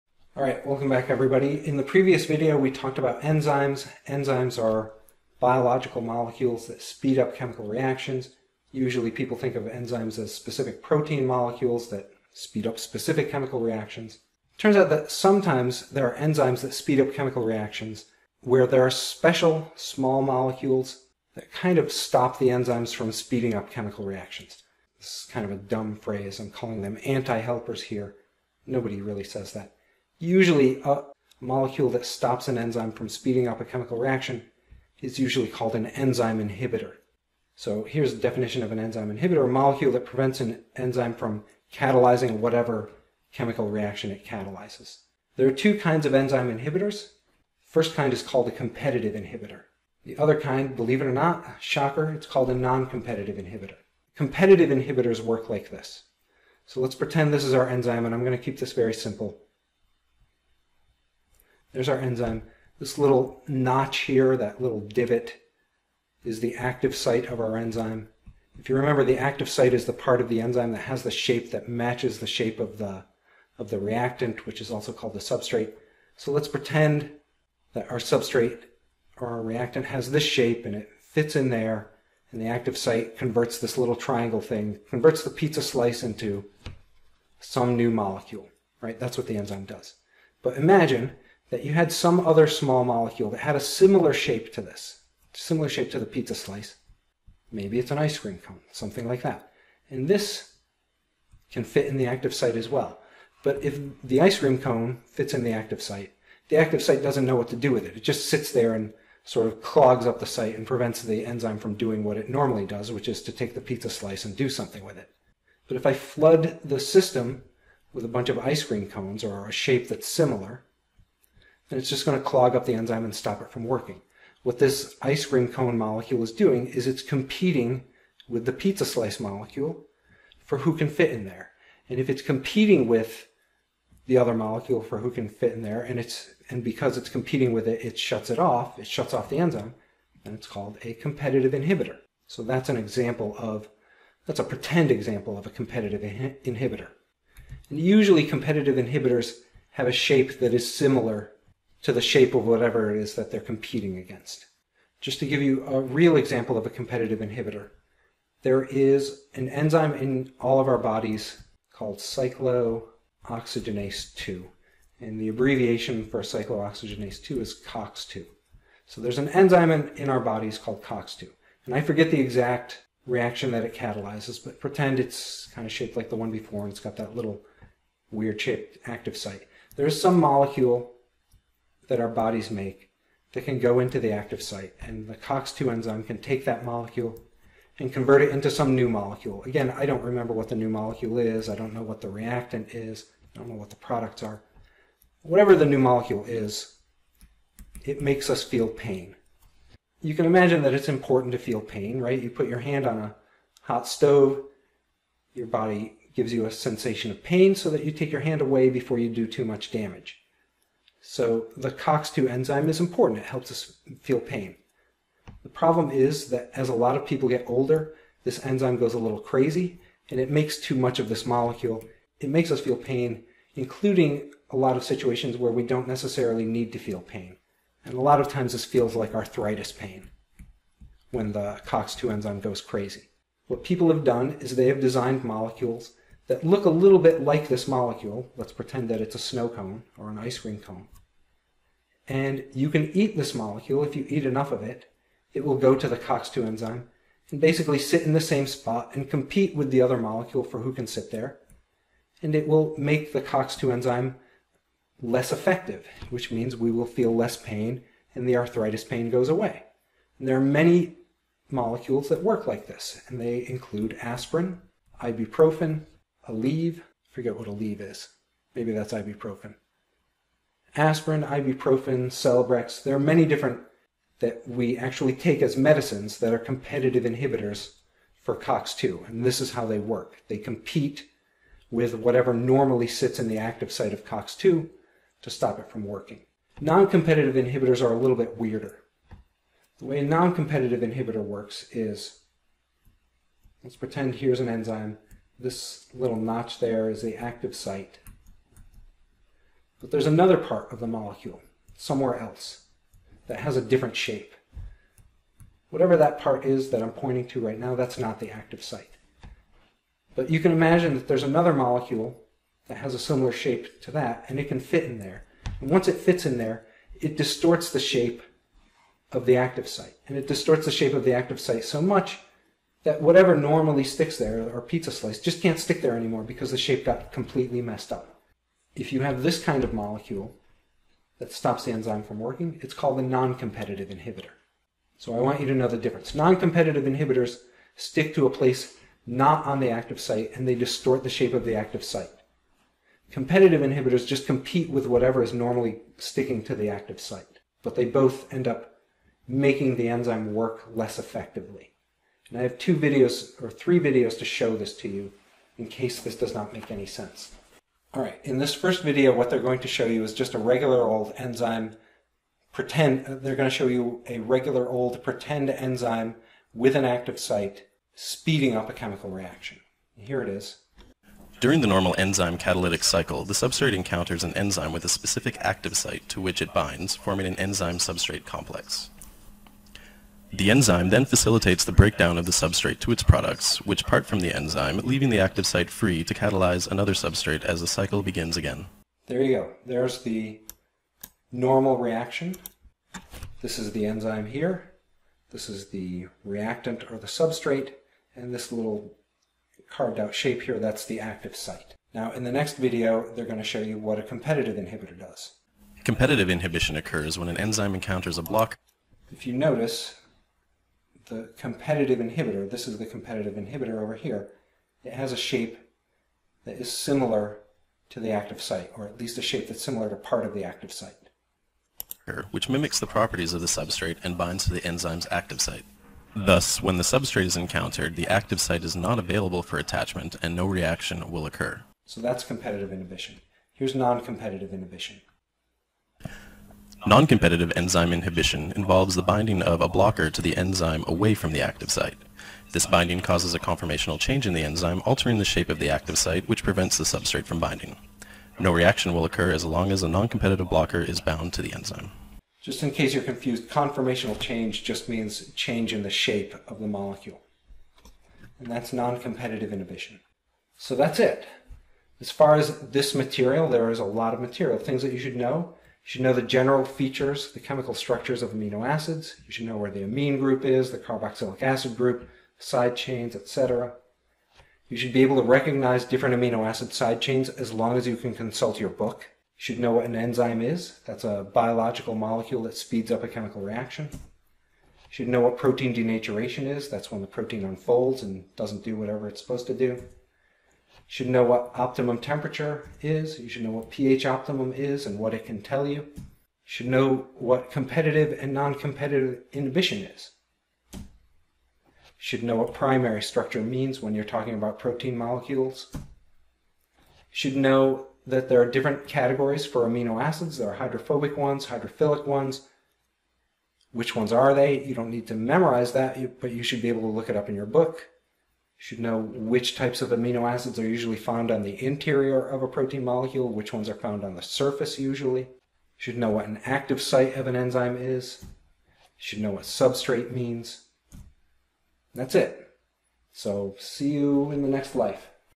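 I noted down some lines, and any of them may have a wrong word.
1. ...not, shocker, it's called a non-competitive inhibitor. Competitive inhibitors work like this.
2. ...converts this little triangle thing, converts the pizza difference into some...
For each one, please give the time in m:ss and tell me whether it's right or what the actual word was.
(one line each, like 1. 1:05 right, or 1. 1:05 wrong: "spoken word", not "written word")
1. 0:51 right
2. 1:23 wrong: "slice", not "difference".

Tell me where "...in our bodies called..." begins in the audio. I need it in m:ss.
2:49.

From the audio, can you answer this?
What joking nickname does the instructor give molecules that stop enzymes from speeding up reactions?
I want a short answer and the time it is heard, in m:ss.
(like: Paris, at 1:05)
anti-helpers, at 0:27.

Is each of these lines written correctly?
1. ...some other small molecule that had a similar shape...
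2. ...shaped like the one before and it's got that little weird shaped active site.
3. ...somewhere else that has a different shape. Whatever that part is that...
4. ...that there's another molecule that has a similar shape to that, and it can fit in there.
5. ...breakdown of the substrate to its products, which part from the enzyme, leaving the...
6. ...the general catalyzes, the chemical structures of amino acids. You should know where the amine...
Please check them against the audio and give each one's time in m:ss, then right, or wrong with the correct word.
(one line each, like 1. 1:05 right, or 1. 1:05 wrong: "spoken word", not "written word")
1. 1:31 right
2. 2:55 right
3. 5:01 right
4. 5:10 right
5. 6:21 right
6. 7:46 wrong: "features", not "catalyzes".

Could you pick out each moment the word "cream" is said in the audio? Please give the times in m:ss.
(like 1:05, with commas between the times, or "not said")
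1:38, 1:44, 1:58, 2:05, 4:00.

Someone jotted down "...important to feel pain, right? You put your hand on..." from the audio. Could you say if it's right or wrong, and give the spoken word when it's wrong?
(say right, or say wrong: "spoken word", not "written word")
right.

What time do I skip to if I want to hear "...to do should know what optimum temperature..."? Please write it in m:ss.
8:09.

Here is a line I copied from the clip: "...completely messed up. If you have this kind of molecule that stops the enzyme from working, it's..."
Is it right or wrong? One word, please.
right.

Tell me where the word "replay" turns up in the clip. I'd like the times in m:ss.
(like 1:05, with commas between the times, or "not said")
not said.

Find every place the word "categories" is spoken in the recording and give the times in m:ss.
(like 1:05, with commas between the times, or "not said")
8:28.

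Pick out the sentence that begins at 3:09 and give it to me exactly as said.
Again, I don't remember what the new molecule is.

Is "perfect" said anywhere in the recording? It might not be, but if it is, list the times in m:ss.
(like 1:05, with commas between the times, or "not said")
not said.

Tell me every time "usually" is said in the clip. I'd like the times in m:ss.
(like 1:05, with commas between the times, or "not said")
0:08, 0:30, 0:35, 2:27, 8:40, 8:44.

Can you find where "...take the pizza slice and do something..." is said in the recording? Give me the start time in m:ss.
1:53.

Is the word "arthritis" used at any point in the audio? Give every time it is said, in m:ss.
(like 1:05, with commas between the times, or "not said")
3:49, 4:18.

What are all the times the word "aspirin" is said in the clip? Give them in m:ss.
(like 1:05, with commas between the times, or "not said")
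4:24, 4:30.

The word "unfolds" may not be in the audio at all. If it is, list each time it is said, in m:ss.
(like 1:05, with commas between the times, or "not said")
8:07.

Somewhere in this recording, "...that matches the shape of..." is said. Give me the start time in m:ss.
1:11.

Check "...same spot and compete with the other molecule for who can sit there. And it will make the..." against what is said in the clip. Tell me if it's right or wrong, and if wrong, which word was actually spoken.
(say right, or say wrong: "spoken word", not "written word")
right.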